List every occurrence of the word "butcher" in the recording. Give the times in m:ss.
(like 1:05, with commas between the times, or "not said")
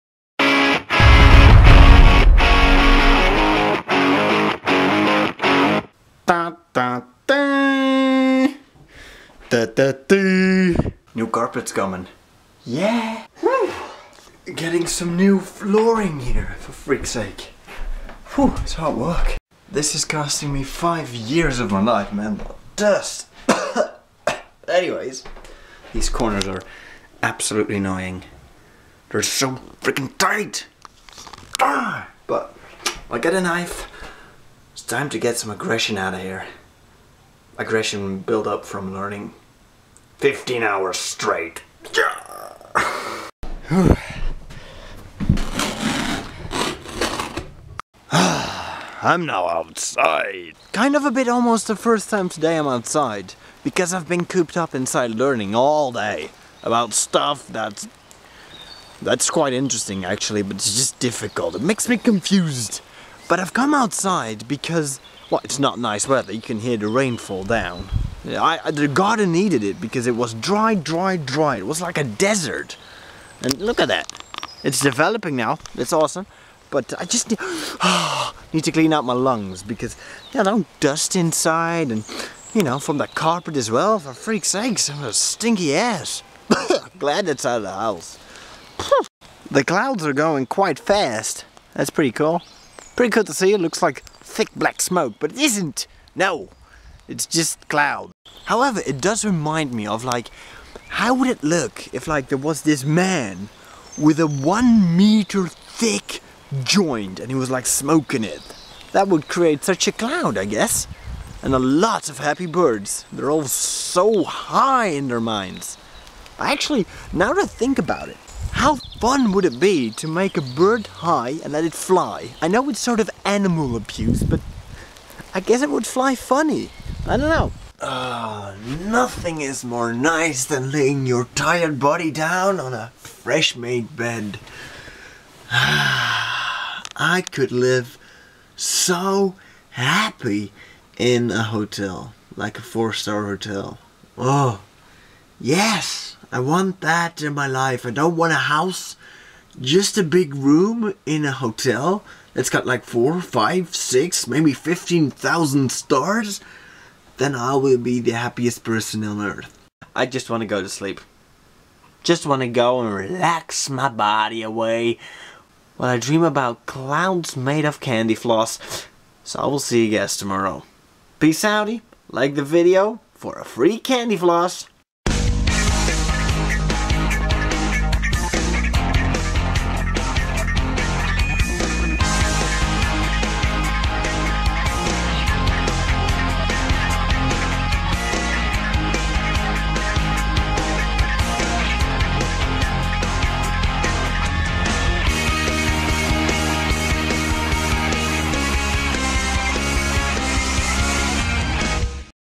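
not said.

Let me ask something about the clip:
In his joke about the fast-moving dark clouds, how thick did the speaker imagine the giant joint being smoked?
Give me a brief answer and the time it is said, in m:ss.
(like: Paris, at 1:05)
1 meter, at 1:44.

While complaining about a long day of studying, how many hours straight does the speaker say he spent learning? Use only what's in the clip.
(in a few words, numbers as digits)
15.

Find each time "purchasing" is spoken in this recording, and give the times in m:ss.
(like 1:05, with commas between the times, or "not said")
not said.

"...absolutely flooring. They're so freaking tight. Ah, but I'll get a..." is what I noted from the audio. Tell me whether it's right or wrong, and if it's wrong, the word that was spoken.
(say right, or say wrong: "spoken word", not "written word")
wrong: "annoying", not "flooring".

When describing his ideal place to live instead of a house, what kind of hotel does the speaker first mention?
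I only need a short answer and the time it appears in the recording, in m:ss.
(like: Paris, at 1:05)
Four star hotel, at 2:22.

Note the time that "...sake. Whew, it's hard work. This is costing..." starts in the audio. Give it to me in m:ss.
0:17.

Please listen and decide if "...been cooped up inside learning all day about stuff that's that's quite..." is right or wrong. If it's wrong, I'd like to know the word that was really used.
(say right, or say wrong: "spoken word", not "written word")
right.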